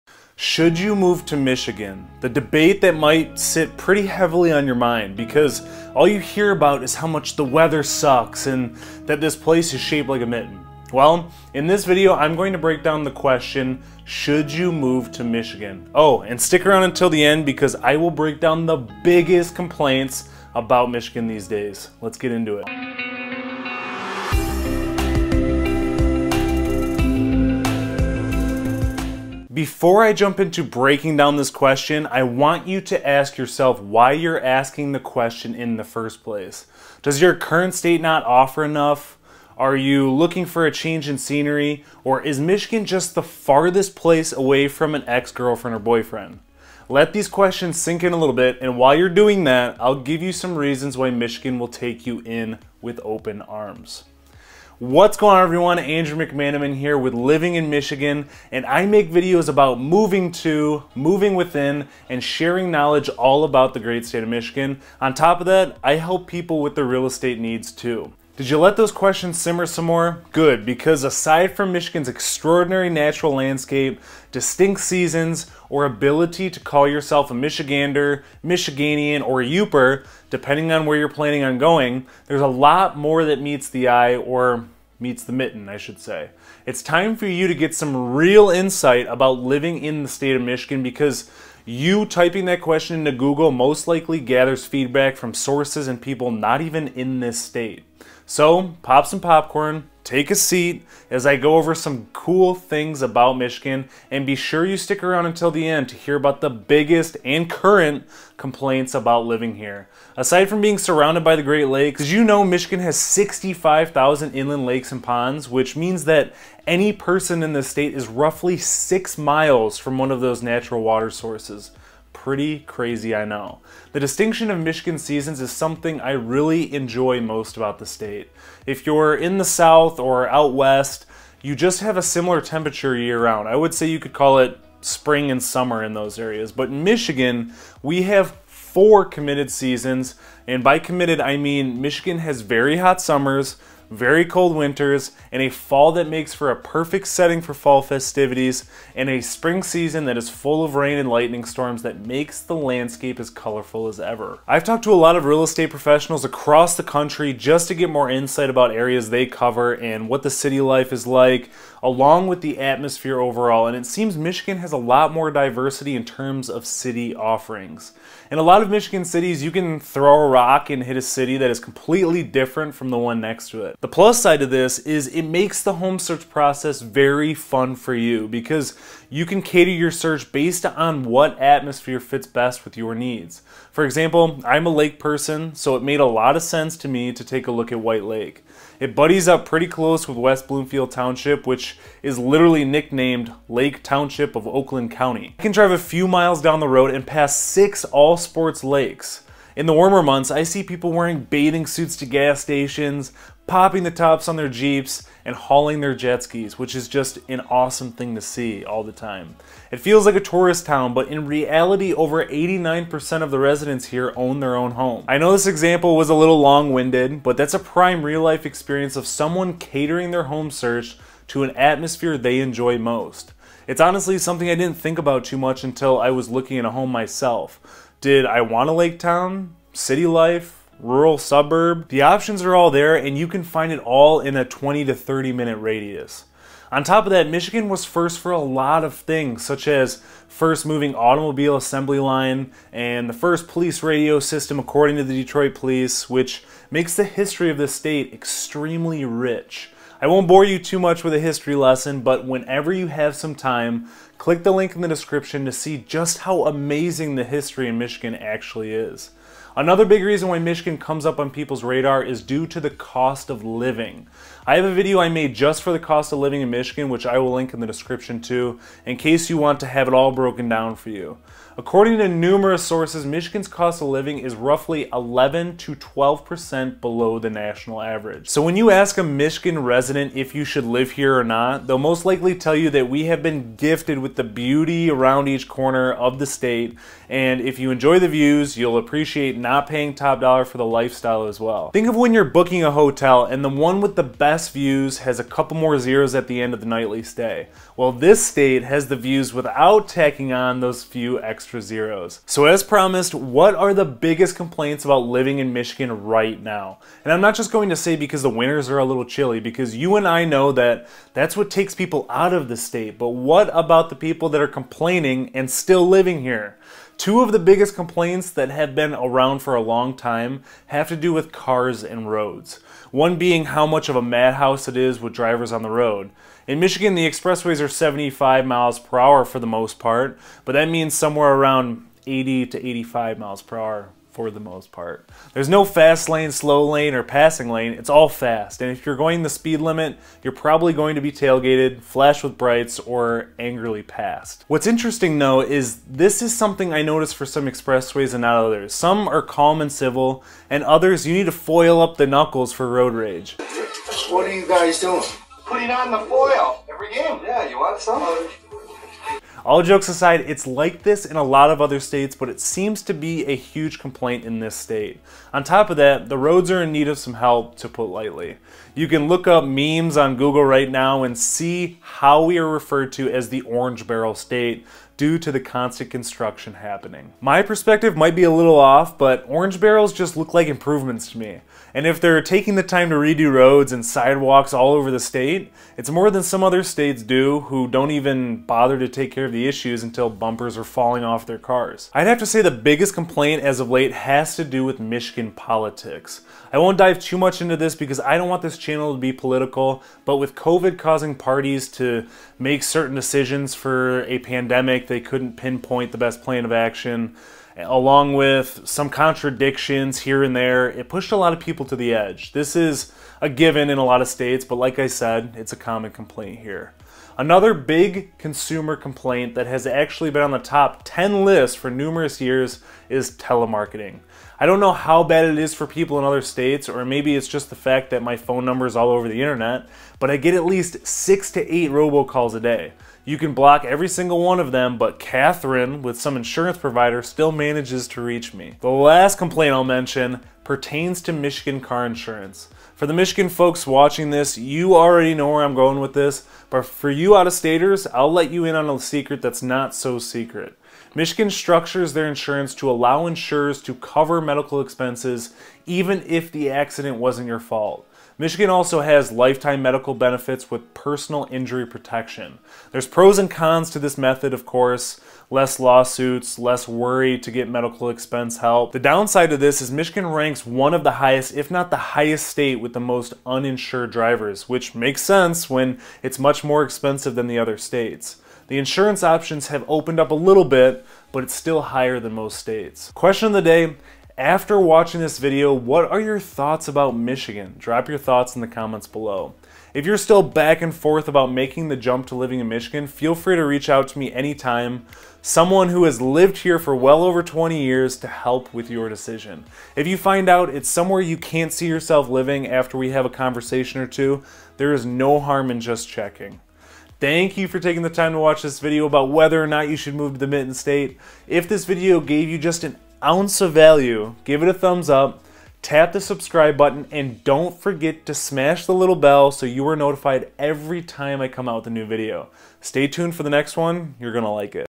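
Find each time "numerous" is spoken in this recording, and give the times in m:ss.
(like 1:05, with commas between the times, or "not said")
4:32, 7:01.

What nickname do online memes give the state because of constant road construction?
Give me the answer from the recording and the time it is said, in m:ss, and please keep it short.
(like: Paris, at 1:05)
Orange Barrel State, at 6:13.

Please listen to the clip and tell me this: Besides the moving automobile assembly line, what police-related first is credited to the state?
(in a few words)
first police radio system.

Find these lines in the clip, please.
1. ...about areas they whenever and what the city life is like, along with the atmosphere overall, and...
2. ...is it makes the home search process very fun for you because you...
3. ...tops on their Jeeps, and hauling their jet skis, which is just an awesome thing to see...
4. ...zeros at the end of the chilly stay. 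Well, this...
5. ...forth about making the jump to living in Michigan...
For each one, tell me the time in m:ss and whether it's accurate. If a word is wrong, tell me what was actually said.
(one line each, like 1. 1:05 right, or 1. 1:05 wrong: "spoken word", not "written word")
1. 2:38 wrong: "cover", not "whenever"
2. 2:54 right
3. 3:23 right
4. 4:55 wrong: "nightly", not "chilly"
5. 8:10 right.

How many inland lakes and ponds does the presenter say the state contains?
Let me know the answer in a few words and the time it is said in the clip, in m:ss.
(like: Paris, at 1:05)
65,000, at 1:52.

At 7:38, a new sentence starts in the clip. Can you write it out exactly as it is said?
Michigan also has lifetime medical benefits with personal injury protection.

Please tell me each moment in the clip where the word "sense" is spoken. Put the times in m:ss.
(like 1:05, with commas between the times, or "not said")
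3:06, 7:55.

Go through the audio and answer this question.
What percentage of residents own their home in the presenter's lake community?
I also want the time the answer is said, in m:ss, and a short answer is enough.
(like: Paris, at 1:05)
89%, at 3:32.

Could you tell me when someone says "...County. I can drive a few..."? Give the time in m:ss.
3:14.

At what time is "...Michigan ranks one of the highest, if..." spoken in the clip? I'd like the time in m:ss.
7:49.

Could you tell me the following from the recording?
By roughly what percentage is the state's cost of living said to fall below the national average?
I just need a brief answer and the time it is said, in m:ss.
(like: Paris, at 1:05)
11 to 12%, at 4:34.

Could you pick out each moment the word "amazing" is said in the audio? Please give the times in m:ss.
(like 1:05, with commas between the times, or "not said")
4:16.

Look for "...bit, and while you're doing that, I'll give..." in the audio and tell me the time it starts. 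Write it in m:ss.
0:48.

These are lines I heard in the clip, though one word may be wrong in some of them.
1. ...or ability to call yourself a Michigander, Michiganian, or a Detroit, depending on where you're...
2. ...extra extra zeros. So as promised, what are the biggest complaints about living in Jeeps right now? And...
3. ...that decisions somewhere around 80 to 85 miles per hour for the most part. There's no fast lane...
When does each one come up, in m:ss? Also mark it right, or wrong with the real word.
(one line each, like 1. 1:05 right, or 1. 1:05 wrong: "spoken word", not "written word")
1. 1:15 wrong: "Yooper", not "Detroit"
2. 5:01 wrong: "Michigan", not "Jeeps"
3. 5:30 wrong: "means", not "decisions".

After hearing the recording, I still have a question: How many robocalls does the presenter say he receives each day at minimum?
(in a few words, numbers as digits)
6 to 8.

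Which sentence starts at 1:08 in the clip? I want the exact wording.
Did you let those questions simmer some more?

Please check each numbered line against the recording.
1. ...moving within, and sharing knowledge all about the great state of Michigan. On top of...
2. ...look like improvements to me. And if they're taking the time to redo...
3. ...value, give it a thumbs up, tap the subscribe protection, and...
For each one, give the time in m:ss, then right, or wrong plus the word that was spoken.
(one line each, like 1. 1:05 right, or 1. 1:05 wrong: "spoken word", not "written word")
1. 1:00 right
2. 6:20 right
3. 8:33 wrong: "button", not "protection".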